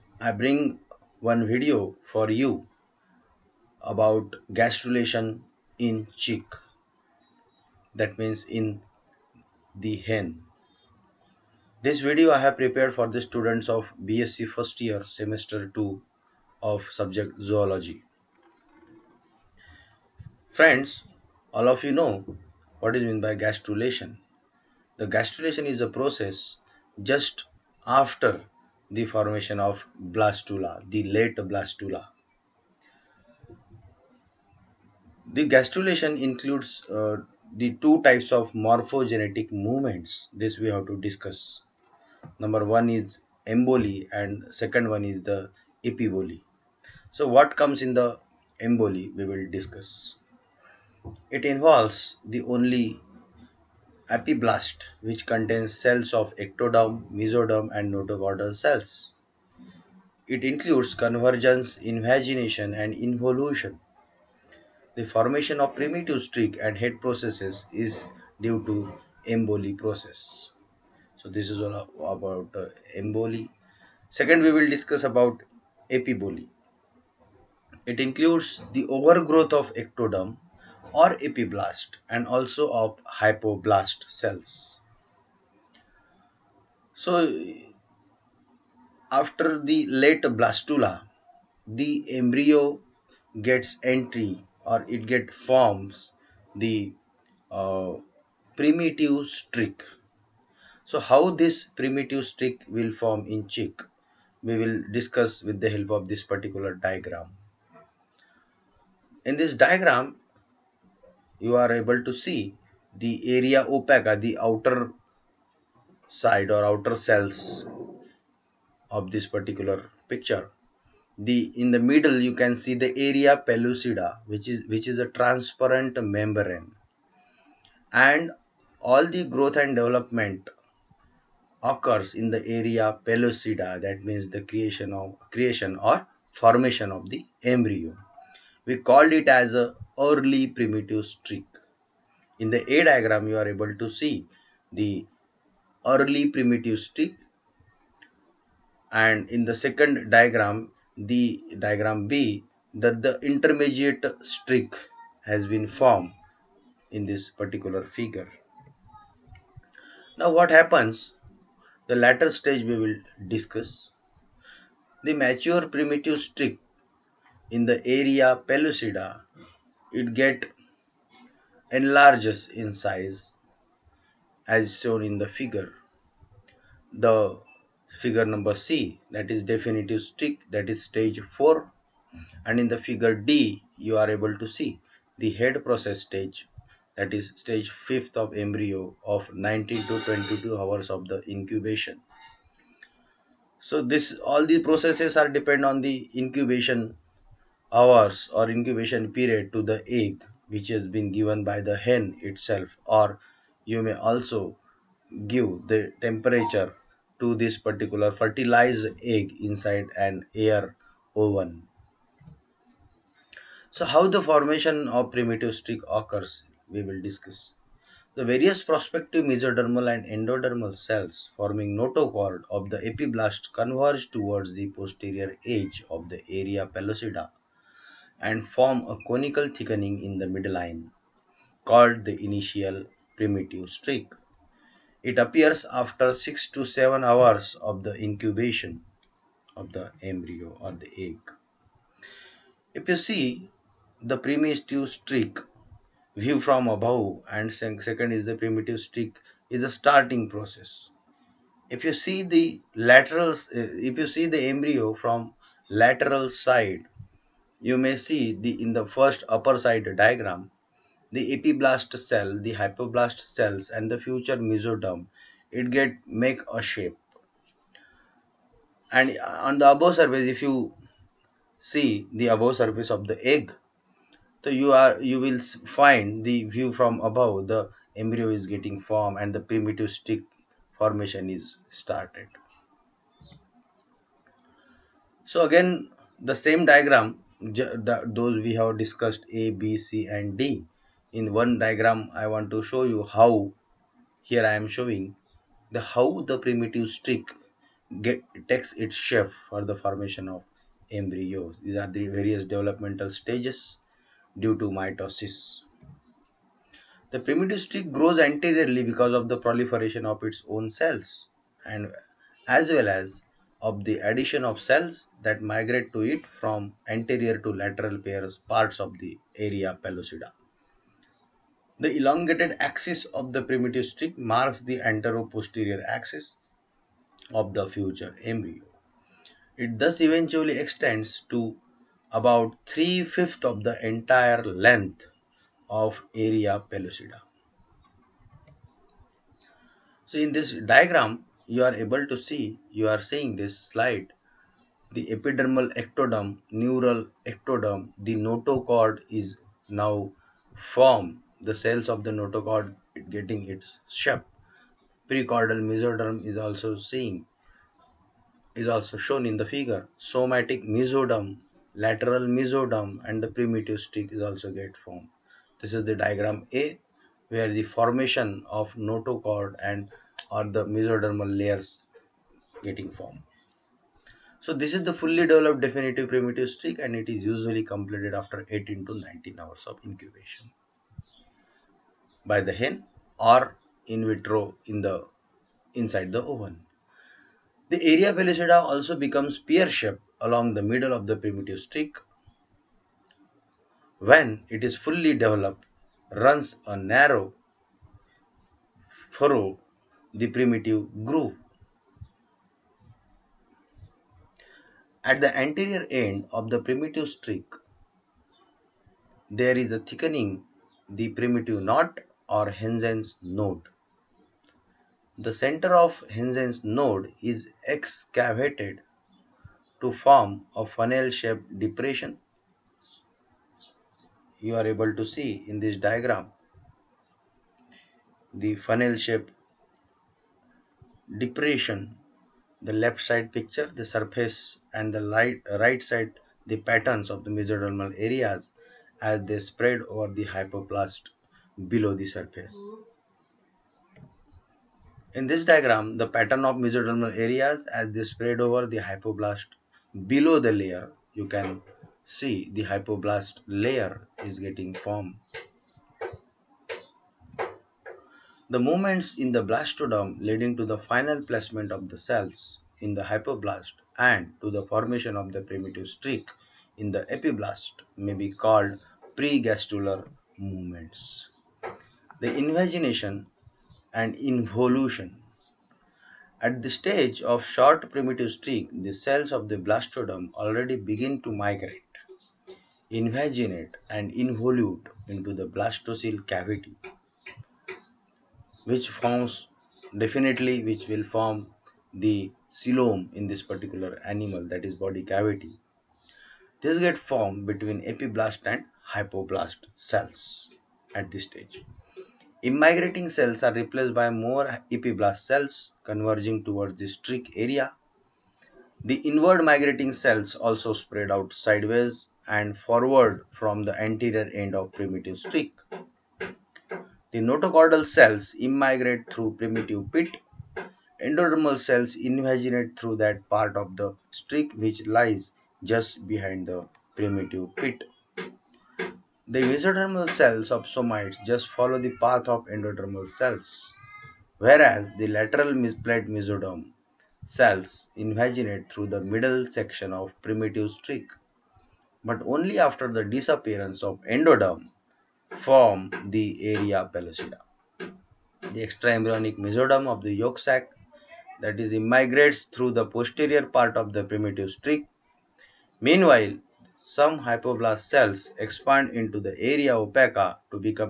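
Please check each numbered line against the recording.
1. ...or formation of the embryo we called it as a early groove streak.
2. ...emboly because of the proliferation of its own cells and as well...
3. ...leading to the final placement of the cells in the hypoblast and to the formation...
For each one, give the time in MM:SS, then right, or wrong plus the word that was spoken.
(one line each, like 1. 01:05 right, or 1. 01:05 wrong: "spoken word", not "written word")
1. 02:15 wrong: "primitive", not "groove"
2. 05:08 wrong: "anteriorly", not "emboly"
3. 07:40 right.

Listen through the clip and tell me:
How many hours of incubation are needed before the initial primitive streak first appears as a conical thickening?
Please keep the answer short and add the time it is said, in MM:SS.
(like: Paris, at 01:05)
6 to 7 hours, at 03:56.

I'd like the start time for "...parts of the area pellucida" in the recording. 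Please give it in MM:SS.
05:18.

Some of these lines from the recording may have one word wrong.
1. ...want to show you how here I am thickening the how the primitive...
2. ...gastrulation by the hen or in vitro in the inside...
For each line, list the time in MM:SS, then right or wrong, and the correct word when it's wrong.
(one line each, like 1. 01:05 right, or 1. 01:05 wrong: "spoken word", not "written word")
1. 04:52 wrong: "showing", not "thickening"
2. 06:19 wrong: "incubation", not "gastrulation".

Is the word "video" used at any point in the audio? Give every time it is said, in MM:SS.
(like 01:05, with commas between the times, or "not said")
00:01, 00:12.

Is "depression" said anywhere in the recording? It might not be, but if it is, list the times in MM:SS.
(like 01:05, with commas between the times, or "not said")
07:01, 07:11.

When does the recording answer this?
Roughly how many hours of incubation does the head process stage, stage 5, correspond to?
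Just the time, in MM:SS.
03:09.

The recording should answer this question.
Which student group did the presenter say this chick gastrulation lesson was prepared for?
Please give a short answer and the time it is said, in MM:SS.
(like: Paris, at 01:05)
BSc first year semester 2, at 00:14.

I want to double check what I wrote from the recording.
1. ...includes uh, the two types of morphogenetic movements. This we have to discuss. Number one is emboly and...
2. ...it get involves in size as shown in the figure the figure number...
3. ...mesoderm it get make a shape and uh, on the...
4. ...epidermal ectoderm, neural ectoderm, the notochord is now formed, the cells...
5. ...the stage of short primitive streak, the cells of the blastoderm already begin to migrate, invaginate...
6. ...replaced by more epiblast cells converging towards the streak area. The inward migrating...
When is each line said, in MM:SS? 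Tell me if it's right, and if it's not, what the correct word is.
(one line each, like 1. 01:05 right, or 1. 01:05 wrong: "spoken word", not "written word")
1. 00:36 right
2. 02:50 wrong: "enlarges", not "involves"
3. 04:24 right
4. 05:45 right
5. 07:56 right
6. 08:23 right.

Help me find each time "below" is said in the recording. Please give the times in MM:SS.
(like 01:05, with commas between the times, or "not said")
07:21, 07:30.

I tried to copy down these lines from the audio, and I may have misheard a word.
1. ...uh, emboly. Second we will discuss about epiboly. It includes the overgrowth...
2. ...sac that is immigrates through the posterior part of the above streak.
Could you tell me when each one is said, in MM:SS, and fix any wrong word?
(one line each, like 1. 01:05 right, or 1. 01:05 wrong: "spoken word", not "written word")
1. 01:12 right
2. 09:10 wrong: "primitive", not "above".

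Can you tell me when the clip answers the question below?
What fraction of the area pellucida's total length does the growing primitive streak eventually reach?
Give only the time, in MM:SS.
05:32.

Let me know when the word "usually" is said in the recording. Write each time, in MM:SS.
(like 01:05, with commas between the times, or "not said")
06:17.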